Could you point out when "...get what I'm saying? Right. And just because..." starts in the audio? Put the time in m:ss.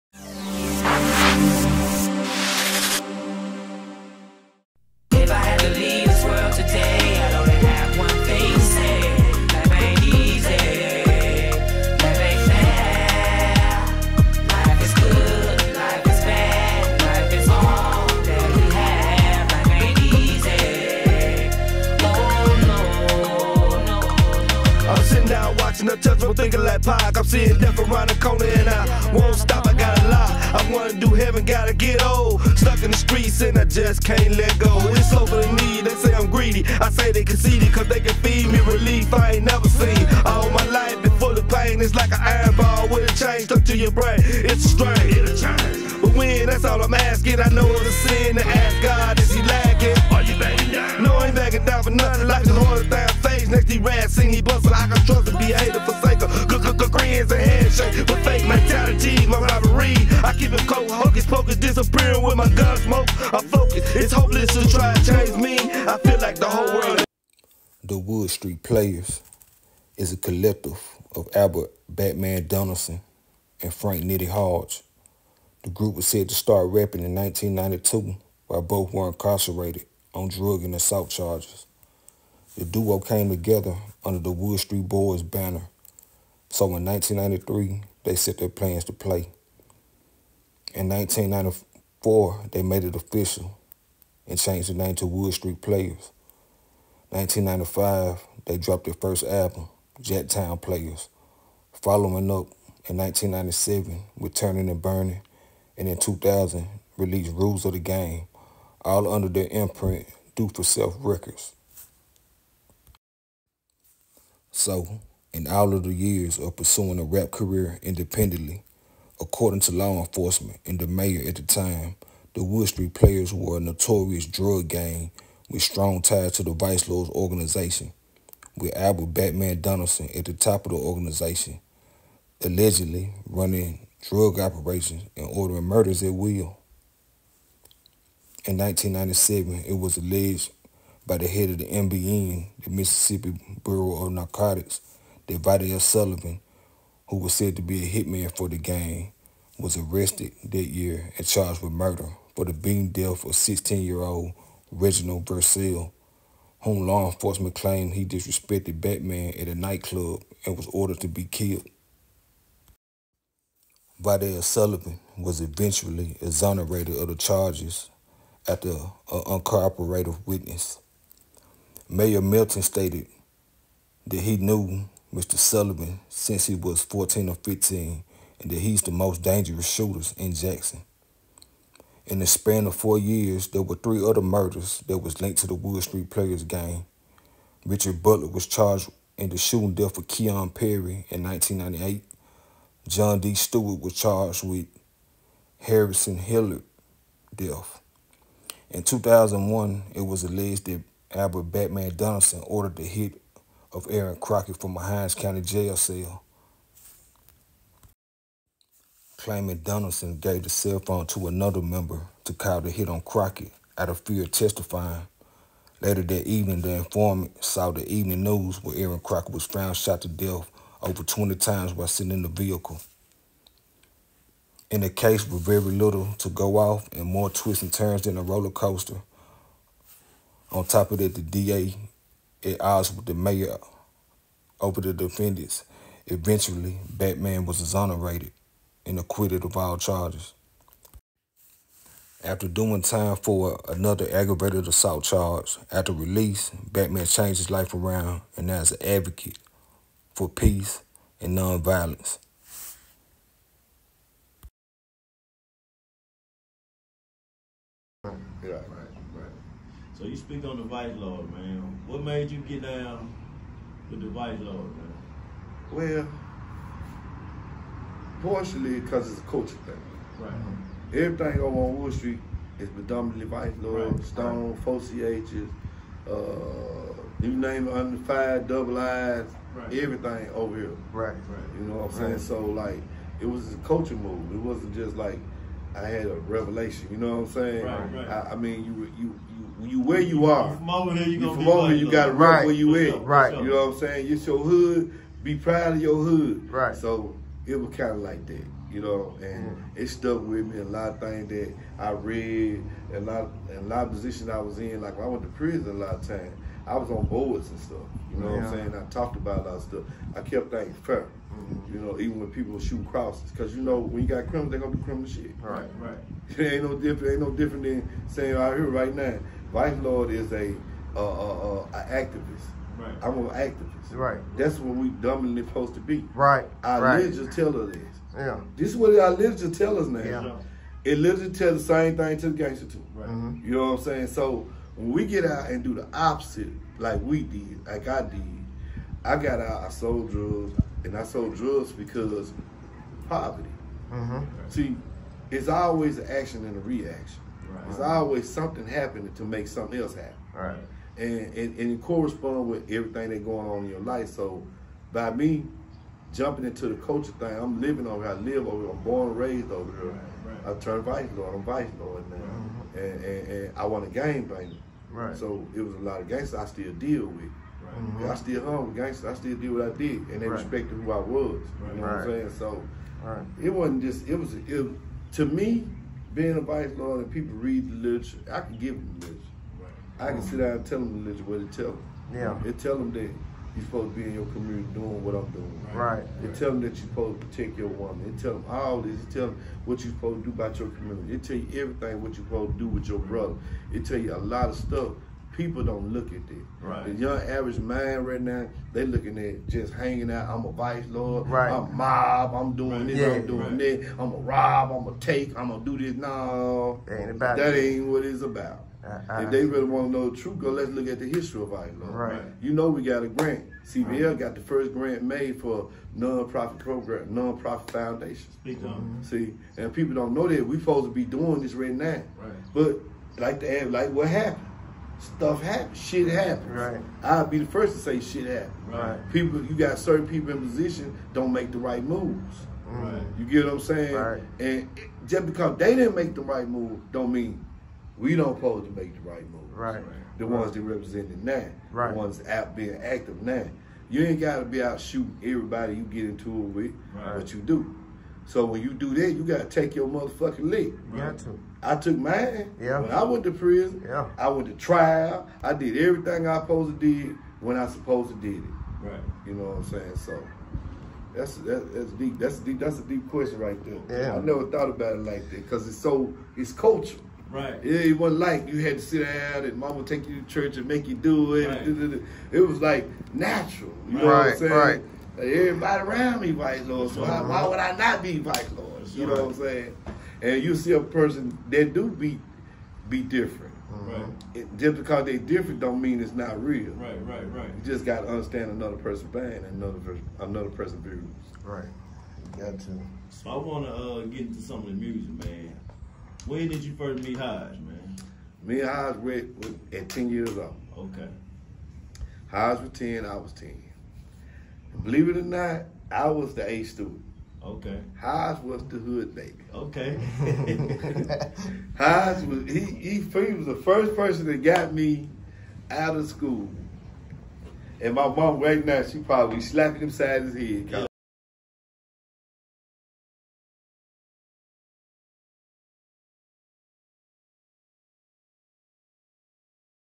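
7:13.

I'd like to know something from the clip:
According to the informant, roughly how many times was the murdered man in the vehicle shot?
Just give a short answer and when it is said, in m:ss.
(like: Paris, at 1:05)
over 20, at 3:40.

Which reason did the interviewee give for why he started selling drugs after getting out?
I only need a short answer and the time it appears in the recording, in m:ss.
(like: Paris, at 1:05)
poverty, at 5:43.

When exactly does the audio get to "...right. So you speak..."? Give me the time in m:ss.
4:19.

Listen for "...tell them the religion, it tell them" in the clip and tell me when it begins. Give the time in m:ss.
6:20.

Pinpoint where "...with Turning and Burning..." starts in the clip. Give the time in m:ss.
1:44.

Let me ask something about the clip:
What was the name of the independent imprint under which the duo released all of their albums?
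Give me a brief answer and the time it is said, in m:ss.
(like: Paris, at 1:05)
Do For Self Records, at 1:50.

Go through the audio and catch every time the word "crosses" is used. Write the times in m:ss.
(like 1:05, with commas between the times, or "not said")
5:12.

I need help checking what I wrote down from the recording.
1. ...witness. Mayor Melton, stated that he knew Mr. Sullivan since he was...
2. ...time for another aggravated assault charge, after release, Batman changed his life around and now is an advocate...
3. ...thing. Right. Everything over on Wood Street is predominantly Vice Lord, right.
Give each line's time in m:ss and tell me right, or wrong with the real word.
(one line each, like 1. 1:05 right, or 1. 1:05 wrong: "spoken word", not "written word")
1. 2:50 right
2. 4:02 right
3. 4:29 right.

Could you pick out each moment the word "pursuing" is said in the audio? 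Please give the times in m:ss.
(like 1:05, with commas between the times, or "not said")
1:56.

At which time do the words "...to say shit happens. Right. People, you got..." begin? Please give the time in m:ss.
7:07.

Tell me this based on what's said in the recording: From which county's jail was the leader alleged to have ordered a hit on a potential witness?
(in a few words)
Hinds County.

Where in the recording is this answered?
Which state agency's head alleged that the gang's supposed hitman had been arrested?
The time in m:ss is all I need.
2:22.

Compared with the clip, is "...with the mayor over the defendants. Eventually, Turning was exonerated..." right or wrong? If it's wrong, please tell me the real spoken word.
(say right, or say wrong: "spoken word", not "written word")
wrong: "Batman", not "Turning".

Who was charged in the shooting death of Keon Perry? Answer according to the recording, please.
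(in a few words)
Richard Butler.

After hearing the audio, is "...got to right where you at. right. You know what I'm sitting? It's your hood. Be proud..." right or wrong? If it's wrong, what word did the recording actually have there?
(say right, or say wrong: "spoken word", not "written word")
wrong: "saying", not "sitting".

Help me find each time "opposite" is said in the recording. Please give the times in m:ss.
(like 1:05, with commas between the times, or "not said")
5:35.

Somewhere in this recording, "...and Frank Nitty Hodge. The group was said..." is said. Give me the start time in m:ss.
1:13.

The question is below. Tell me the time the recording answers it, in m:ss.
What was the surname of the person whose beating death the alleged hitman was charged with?
2:35.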